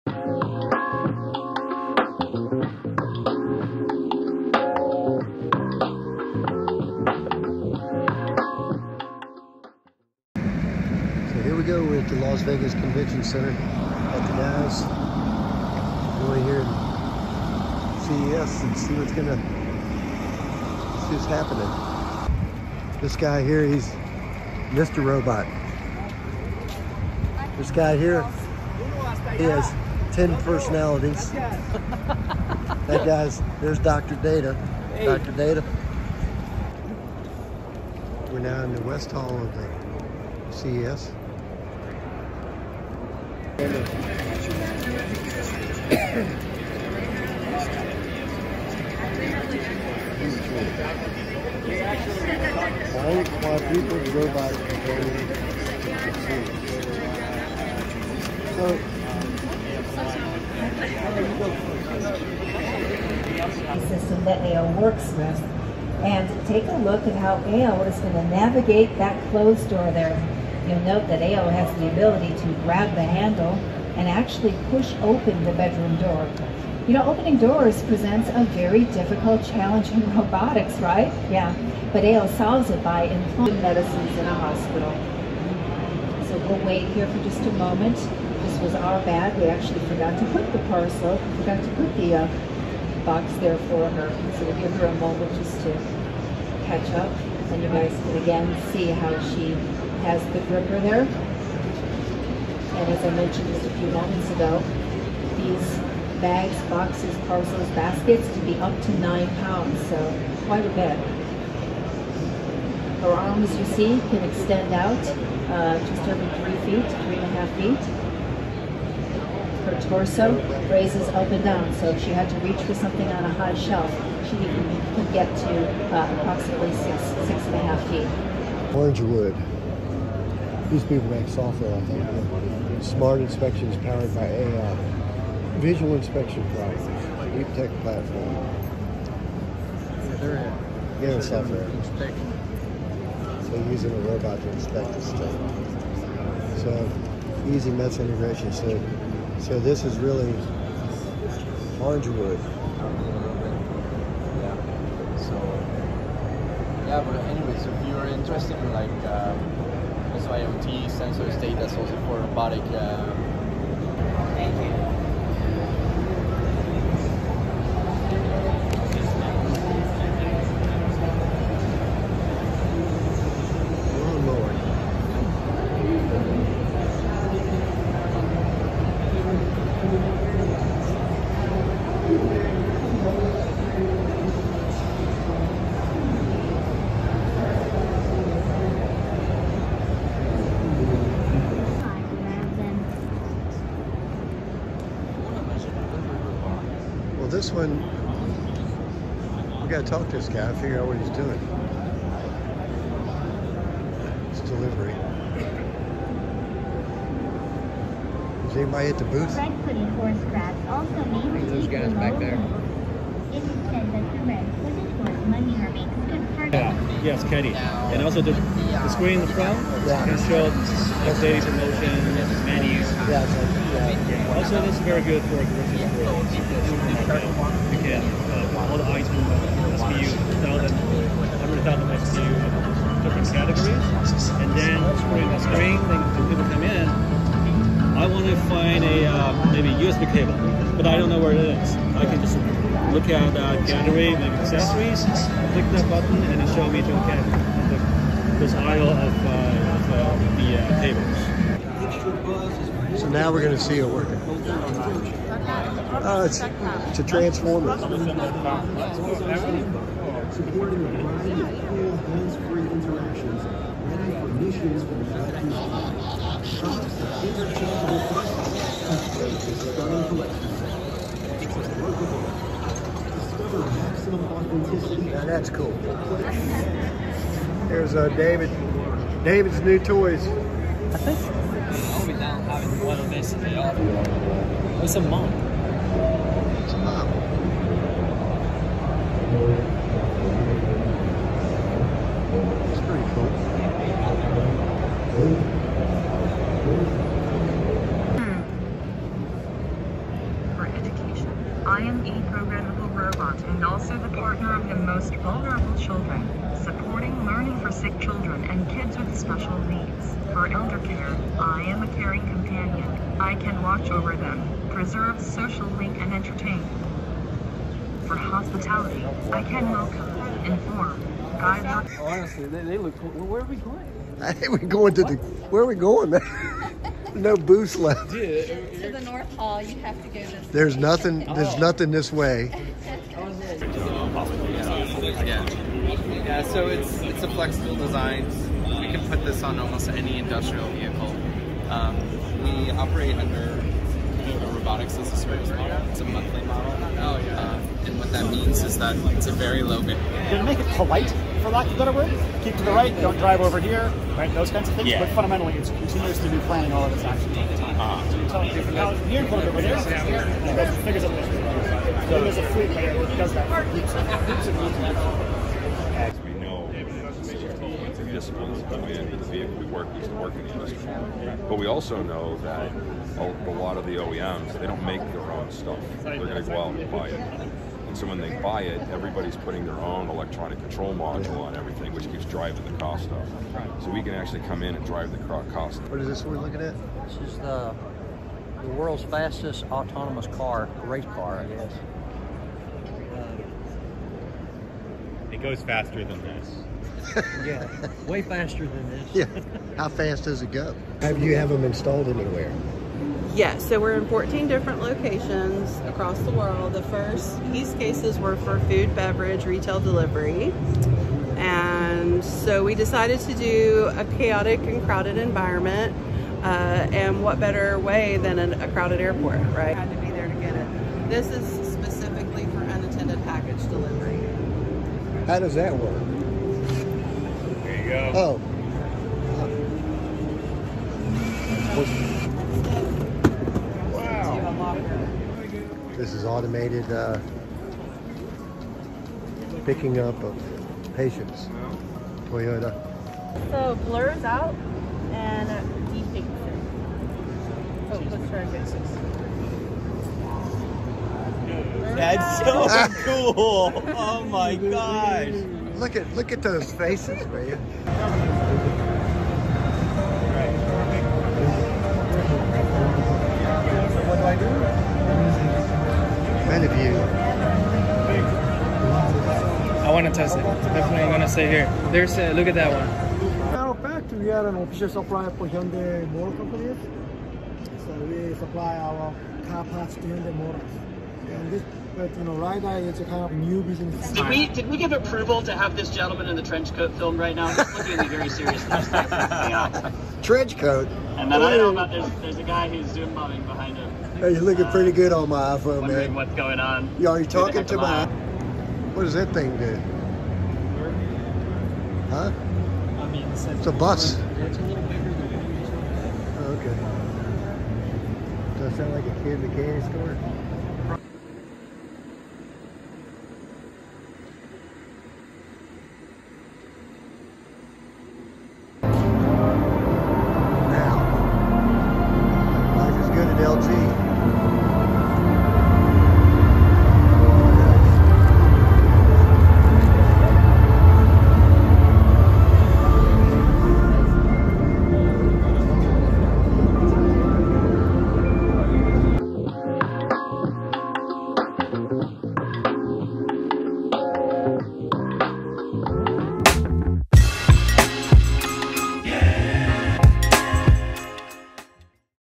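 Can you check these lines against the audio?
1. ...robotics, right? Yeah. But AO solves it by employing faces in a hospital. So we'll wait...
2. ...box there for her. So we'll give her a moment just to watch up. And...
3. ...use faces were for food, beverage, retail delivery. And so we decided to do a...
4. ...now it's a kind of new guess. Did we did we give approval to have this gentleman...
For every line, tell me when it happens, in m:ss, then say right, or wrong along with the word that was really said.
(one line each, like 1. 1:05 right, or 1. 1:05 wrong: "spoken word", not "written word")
1. 1:20 wrong: "medicines", not "faces"
2. 1:33 wrong: "catch", not "watch"
3. 6:47 wrong: "cases", not "faces"
4. 8:02 wrong: "business", not "guess".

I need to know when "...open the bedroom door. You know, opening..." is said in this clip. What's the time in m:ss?
1:15.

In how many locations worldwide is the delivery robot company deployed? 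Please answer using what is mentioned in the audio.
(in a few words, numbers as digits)
14.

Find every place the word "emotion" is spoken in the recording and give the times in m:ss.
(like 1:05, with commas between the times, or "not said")
not said.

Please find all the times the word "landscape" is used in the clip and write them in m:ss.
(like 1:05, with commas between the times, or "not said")
not said.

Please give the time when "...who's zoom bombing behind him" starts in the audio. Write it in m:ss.
8:12.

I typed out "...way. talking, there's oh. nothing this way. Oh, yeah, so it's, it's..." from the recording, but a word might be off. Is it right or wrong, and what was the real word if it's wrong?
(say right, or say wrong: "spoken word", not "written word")
wrong: "nothing", not "talking".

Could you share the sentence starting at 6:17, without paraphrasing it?
And so when they buy it, everybody's putting their own electronic control module on everything, which keeps driving the cost up.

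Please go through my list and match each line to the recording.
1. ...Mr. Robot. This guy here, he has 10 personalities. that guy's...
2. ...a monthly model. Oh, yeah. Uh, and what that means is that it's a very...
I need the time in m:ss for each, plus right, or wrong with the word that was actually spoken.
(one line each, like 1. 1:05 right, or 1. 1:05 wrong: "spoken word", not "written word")
1. 0:24 right
2. 5:45 right.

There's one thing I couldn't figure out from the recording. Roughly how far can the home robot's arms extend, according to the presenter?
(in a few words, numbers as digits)
3.5 feet.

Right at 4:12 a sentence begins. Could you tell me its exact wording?
So now we're going to see it working.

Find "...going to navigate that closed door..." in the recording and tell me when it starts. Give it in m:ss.
1:07.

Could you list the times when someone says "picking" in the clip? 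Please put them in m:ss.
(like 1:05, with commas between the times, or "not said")
7:19.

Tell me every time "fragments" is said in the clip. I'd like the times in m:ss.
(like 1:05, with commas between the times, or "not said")
not said.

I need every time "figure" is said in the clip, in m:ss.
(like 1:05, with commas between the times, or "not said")
3:20, 6:00.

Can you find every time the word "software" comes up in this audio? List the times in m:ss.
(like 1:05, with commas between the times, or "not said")
2:11, 2:21.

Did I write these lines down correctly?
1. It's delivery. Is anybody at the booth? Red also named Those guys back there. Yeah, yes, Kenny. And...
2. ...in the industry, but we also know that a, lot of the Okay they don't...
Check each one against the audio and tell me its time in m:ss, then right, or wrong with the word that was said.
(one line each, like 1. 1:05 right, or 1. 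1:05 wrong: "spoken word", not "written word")
1. 3:24 right
2. 6:10 wrong: "OEMs", not "Okay".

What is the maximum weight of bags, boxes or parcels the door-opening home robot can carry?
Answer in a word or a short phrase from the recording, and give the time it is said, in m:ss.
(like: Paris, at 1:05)
9 pounds, at 1:48.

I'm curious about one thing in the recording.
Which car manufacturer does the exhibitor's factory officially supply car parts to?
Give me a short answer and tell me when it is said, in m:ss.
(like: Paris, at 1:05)
Hyundai Motor Company, at 7:55.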